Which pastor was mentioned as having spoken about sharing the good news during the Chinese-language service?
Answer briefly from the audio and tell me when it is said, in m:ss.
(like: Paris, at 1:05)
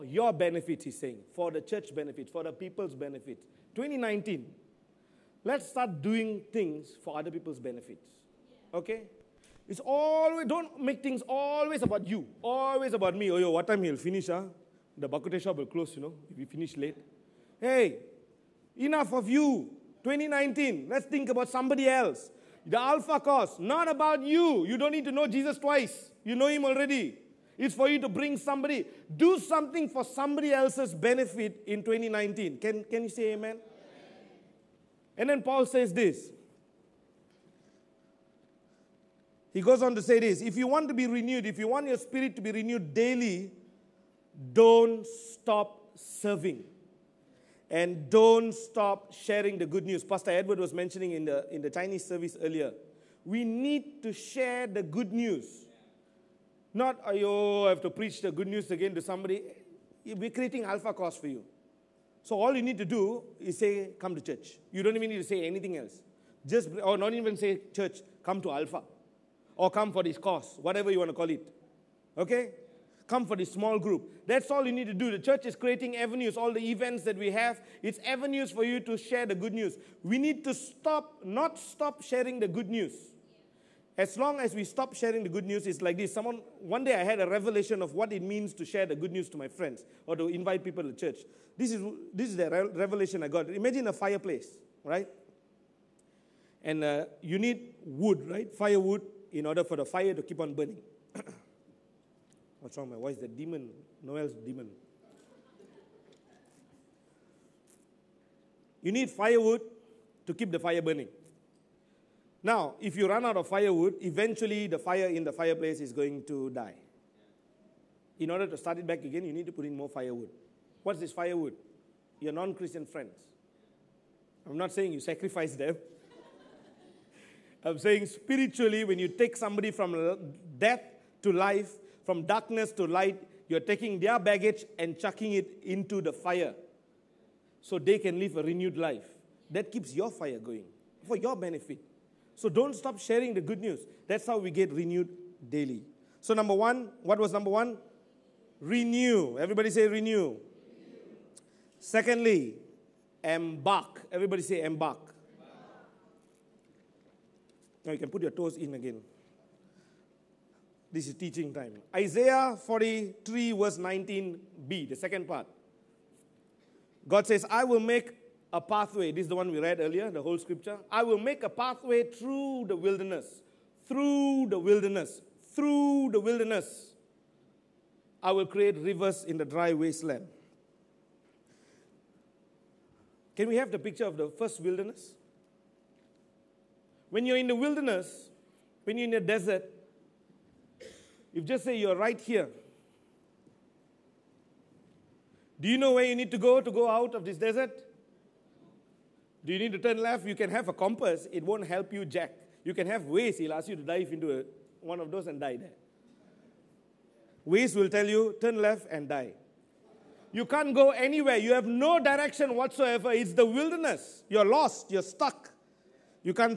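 Pastor Edward, at 0:50.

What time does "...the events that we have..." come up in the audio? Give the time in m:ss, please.
1:16.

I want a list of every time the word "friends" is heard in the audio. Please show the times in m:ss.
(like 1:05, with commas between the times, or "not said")
1:29, 2:02.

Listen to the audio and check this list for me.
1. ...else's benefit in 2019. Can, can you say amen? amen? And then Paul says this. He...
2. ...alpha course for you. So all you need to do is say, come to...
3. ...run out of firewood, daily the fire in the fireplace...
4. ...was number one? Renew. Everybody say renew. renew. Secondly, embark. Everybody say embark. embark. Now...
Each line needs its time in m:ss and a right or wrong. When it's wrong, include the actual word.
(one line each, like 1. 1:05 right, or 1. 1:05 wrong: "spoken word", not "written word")
1. 0:30 right
2. 1:00 right
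3. 1:53 wrong: "eventually", not "daily"
4. 2:27 right.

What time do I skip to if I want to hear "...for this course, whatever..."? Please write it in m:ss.
1:09.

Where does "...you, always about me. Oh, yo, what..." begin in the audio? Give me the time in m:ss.
0:12.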